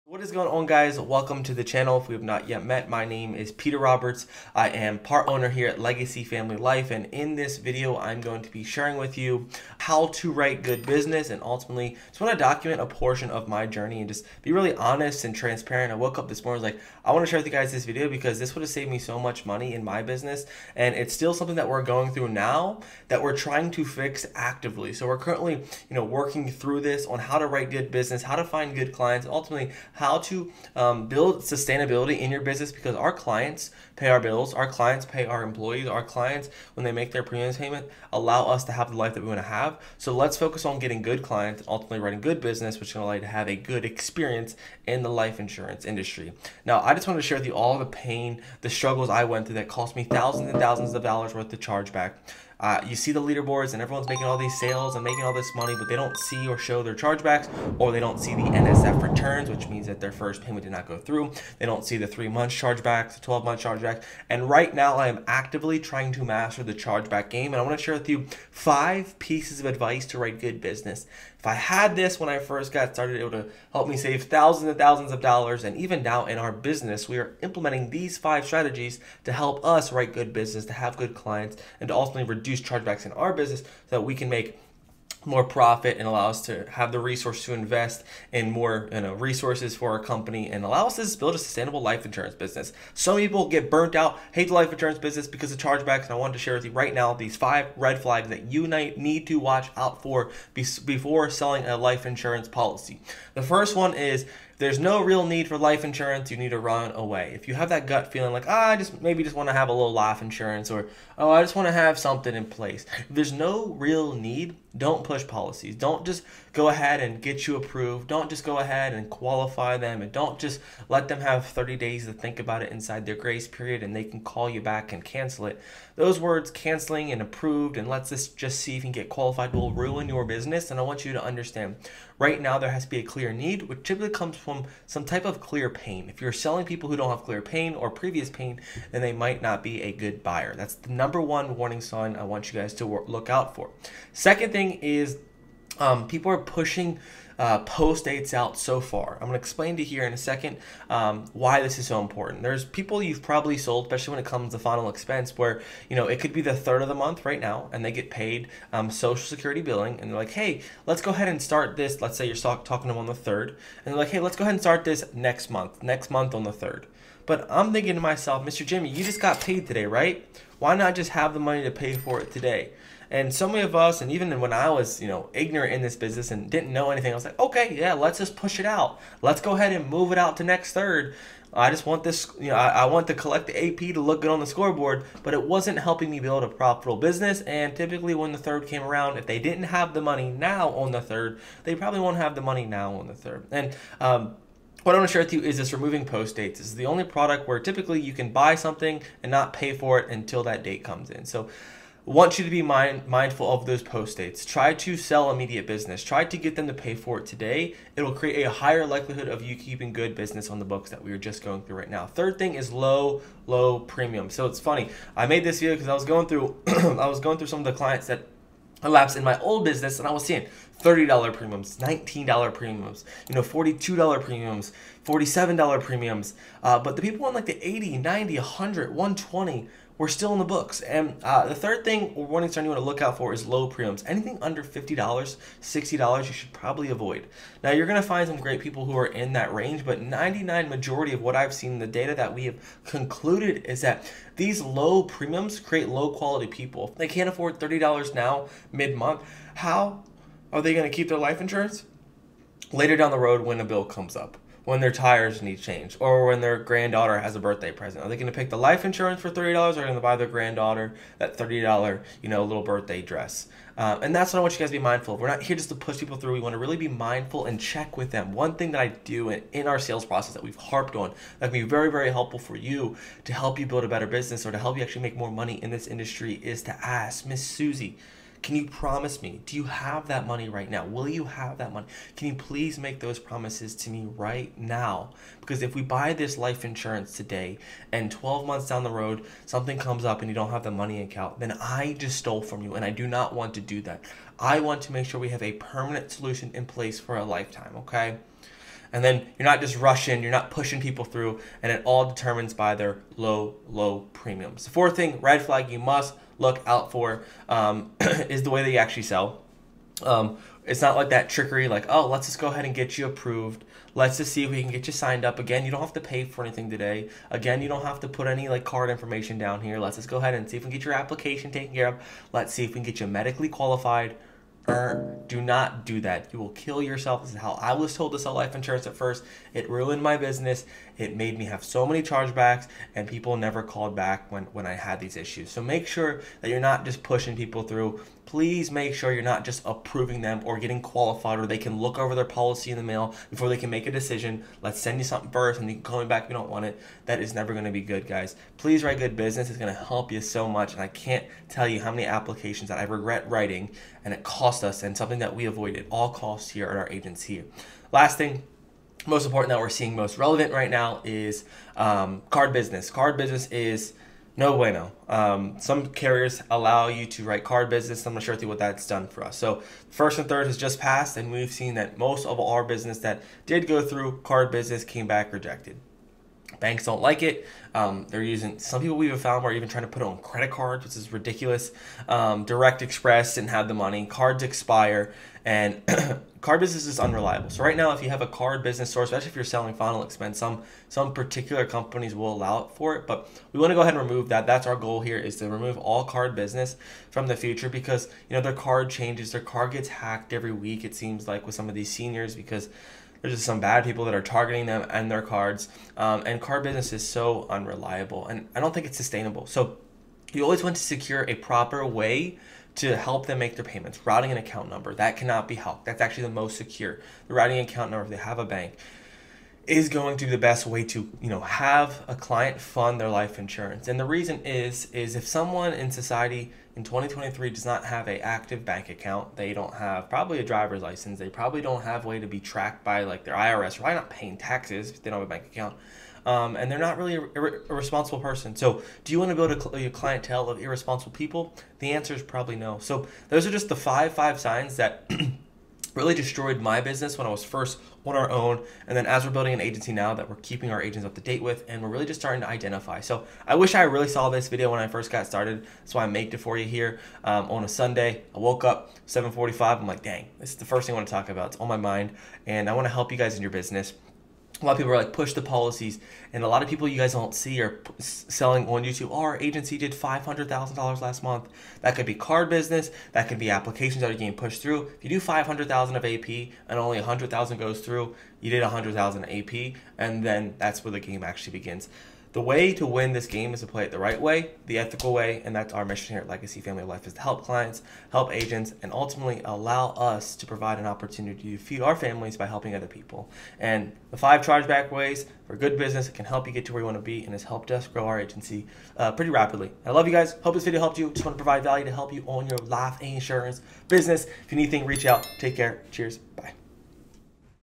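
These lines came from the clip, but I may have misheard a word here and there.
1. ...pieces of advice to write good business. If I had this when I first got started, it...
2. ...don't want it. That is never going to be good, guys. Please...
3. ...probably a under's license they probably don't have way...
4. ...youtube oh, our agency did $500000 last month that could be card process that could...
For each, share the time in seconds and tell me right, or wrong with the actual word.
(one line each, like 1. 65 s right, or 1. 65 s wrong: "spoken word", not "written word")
1. 69 s right
2. 346 s right
3. 430 s wrong: "driver", not "under"
4. 468 s wrong: "business", not "process".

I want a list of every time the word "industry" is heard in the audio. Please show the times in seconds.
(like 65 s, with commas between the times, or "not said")
45 s, 275 s.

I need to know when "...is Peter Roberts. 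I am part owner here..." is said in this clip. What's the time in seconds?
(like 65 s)
3 s.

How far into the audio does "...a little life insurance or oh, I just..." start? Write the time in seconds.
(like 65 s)
109 s.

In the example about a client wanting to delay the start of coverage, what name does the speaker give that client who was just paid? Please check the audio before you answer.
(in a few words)
Mr. Jimmy.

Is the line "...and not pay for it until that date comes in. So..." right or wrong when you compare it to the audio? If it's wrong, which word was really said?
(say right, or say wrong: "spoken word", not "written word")
right.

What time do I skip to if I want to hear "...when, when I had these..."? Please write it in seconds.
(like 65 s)
334 s.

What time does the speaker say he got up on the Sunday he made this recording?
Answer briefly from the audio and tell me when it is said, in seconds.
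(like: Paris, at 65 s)
7:45, at 459 s.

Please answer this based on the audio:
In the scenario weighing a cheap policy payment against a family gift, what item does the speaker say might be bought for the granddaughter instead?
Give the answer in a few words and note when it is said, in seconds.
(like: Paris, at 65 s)
birthday dress, at 262 s.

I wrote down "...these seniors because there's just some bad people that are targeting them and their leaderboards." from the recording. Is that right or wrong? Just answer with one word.
wrong.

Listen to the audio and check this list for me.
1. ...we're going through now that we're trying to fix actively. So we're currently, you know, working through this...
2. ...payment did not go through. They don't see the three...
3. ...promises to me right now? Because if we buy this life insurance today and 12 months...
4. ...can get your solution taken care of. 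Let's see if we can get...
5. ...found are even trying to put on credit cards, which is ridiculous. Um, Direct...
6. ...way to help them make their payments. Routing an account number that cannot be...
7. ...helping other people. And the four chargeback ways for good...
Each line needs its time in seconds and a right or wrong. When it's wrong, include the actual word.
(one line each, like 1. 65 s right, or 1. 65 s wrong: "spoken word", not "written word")
1. 21 s right
2. 60 s right
3. 283 s right
4. 320 s wrong: "application", not "solution"
5. 379 s right
6. 411 s right
7. 492 s wrong: "five", not "four".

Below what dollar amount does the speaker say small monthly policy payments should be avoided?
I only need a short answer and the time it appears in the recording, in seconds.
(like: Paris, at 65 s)
$50, at 234 s.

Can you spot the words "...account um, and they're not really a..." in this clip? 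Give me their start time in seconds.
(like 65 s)
435 s.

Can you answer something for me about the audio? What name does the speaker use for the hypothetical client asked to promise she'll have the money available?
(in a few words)
Miss Susie.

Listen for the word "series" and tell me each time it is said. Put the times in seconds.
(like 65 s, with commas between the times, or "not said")
not said.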